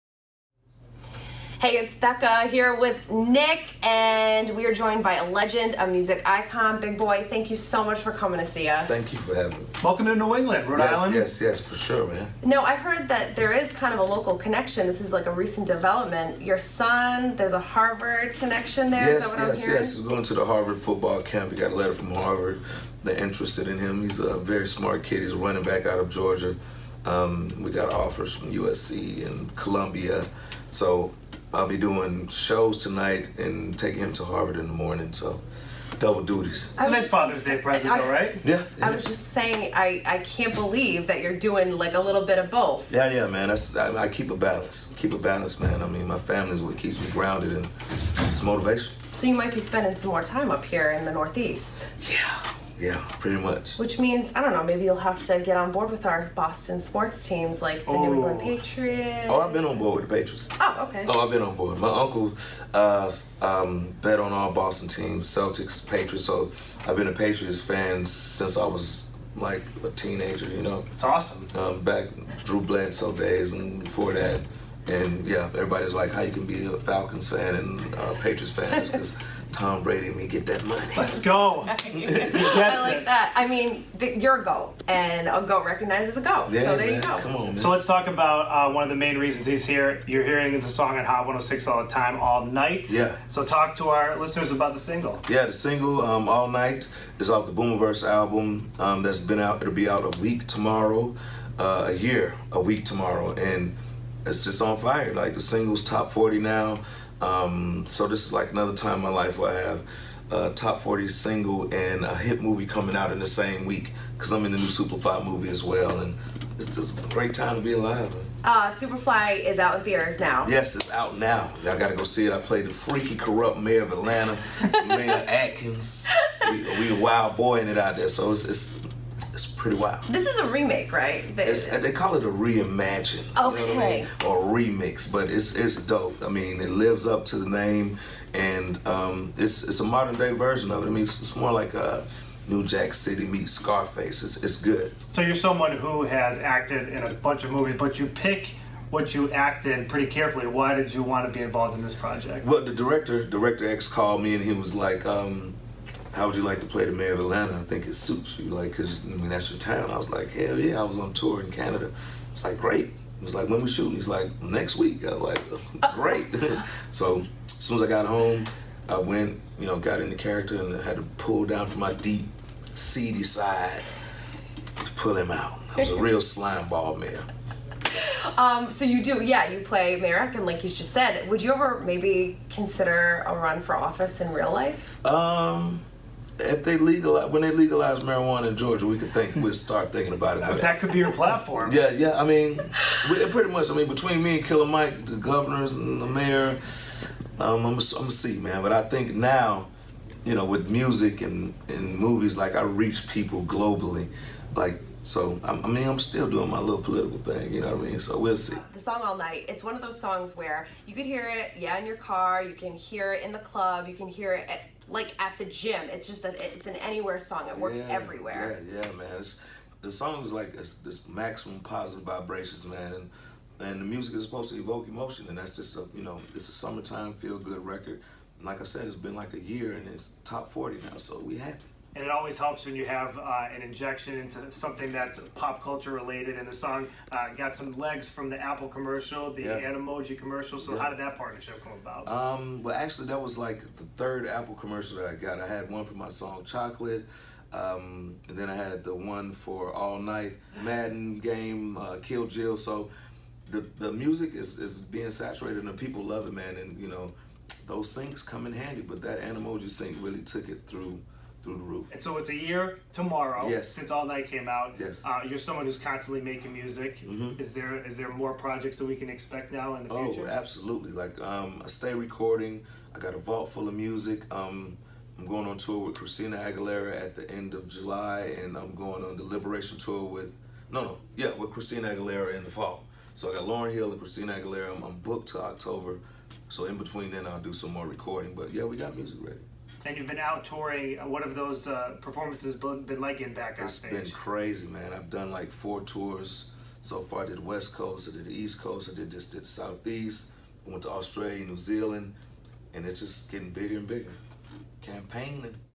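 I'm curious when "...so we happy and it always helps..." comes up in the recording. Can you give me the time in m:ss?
3:50.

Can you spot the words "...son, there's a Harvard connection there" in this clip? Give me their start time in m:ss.
0:16.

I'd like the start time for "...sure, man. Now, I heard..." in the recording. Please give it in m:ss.
0:11.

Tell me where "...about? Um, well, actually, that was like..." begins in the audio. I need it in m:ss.
4:01.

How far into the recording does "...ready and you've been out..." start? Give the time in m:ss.
4:49.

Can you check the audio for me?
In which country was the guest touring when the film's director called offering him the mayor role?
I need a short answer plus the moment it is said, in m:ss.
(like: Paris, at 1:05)
Canada, at 2:41.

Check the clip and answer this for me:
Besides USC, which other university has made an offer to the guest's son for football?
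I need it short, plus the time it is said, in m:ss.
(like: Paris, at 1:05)
Columbia, at 0:29.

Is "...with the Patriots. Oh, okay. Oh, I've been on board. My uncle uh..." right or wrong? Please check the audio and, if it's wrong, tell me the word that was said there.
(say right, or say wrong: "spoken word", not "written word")
right.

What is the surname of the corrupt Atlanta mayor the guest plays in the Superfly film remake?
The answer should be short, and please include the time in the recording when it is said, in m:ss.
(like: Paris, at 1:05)
Atkins, at 2:05.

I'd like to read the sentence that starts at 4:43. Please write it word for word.
So I got Lauryn Hill and Christina Aguilera.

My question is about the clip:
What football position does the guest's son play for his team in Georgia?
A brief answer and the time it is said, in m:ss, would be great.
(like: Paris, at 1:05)
Running back, at 0:25.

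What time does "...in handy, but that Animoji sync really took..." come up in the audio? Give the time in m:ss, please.
4:18.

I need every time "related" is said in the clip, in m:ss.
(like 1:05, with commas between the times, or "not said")
3:55.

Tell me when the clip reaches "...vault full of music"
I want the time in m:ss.
4:33.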